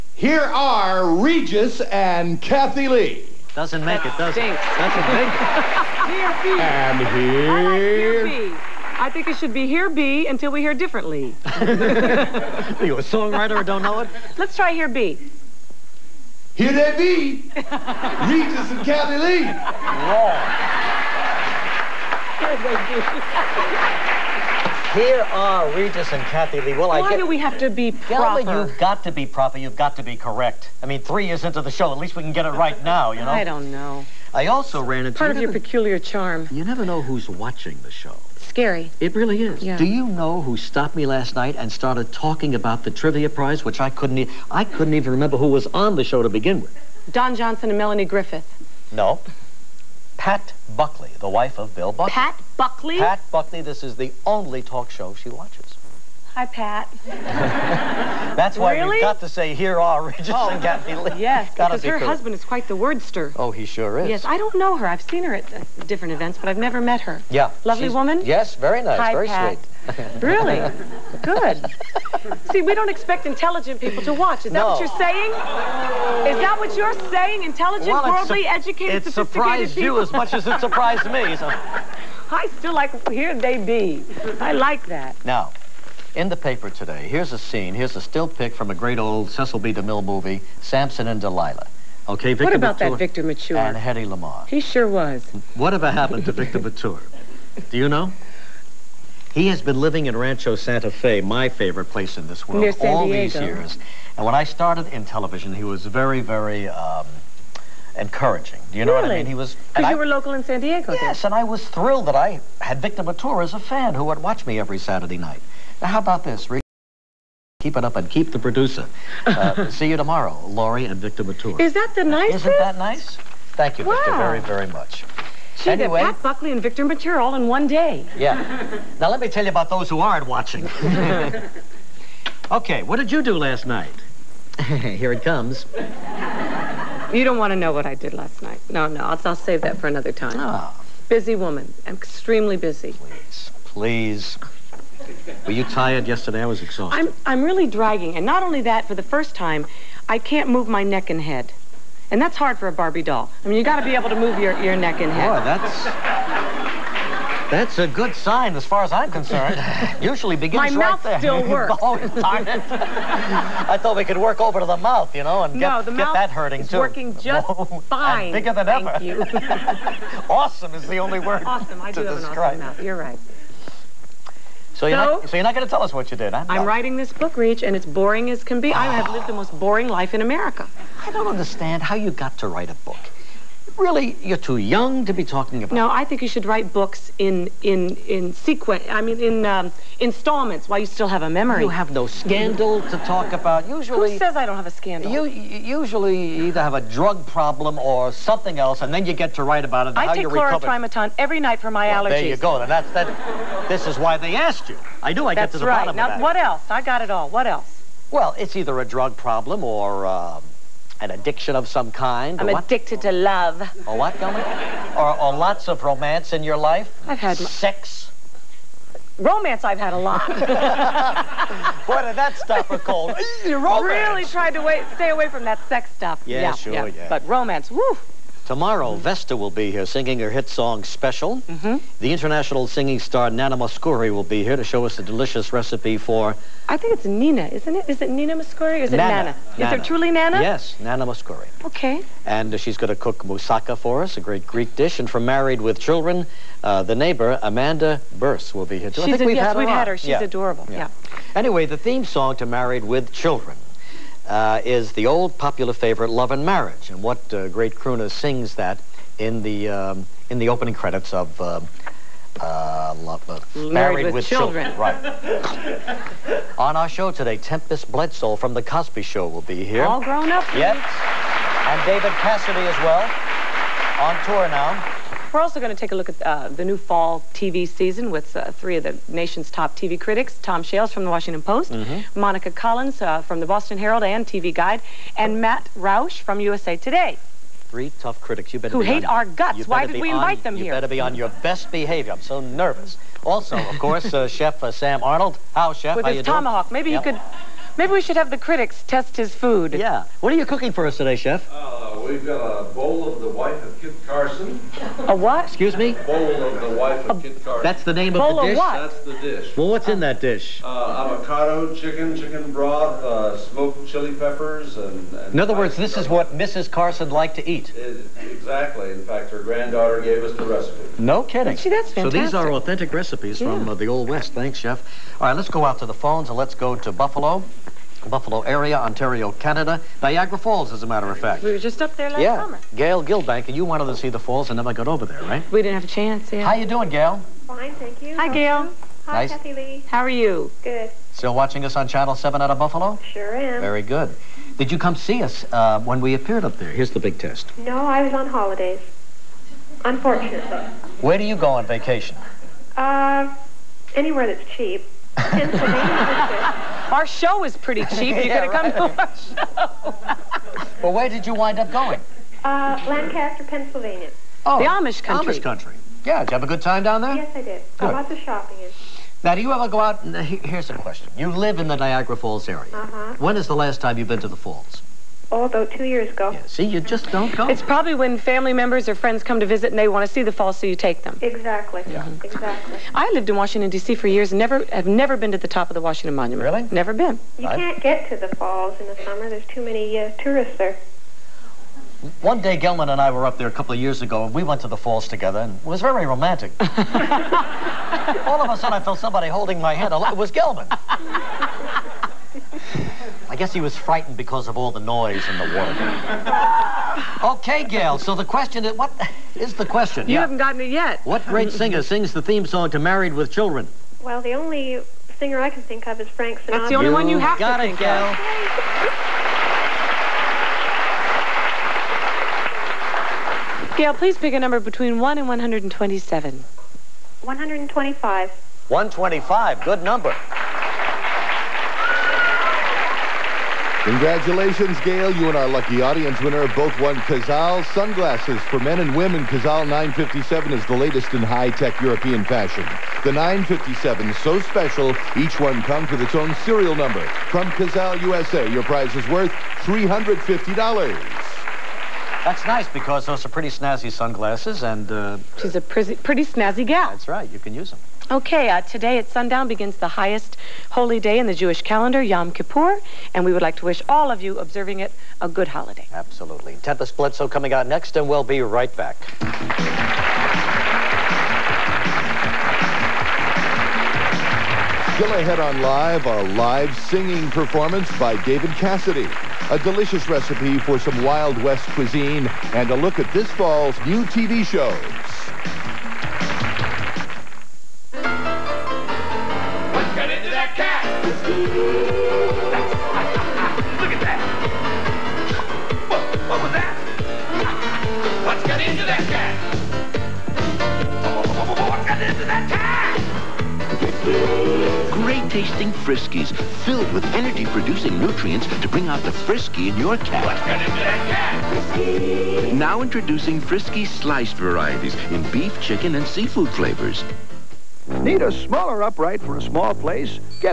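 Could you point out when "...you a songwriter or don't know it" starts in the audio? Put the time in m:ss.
0:12.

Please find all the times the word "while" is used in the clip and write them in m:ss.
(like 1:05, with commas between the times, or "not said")
3:10.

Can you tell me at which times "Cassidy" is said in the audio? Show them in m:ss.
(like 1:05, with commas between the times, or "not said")
4:32, 7:58.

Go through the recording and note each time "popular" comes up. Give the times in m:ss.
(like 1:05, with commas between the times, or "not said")
4:15.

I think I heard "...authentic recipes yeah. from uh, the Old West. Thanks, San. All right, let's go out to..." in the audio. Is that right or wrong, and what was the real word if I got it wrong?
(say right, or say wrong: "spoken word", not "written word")
wrong: "Chef", not "San".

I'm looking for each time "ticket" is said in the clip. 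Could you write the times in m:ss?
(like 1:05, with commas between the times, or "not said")
not said.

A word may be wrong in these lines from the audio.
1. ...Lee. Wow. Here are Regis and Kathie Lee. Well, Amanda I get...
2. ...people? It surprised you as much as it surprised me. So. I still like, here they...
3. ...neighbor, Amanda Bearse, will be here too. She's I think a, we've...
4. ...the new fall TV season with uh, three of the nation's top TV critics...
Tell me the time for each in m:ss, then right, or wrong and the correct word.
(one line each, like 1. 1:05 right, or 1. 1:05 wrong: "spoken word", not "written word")
1. 0:19 wrong: "Why", not "Amanda"
2. 1:19 right
3. 4:06 right
4. 4:36 right.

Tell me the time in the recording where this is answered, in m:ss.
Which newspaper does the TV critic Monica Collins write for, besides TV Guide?
4:43.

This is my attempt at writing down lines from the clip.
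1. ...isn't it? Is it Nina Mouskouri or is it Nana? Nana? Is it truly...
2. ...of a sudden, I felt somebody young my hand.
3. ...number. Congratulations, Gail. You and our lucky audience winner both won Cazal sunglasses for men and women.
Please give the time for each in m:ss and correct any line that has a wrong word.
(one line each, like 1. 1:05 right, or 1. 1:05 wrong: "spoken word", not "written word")
1. 3:57 right
2. 6:38 wrong: "holding", not "young"
3. 7:09 right.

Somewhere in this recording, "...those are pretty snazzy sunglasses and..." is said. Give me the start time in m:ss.
7:33.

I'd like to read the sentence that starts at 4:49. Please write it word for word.
Why did we on, invite them you here?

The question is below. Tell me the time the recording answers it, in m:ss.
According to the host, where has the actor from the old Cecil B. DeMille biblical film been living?
1:40.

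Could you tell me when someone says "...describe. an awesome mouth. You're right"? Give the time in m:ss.
2:52.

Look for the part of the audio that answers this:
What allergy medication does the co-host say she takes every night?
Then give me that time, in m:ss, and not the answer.
3:20.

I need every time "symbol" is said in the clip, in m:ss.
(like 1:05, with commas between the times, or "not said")
not said.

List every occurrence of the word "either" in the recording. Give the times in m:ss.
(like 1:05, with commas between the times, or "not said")
3:16, 3:28.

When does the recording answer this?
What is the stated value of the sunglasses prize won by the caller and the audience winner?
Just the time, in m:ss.
7:29.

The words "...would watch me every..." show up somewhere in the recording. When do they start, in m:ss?
1:54.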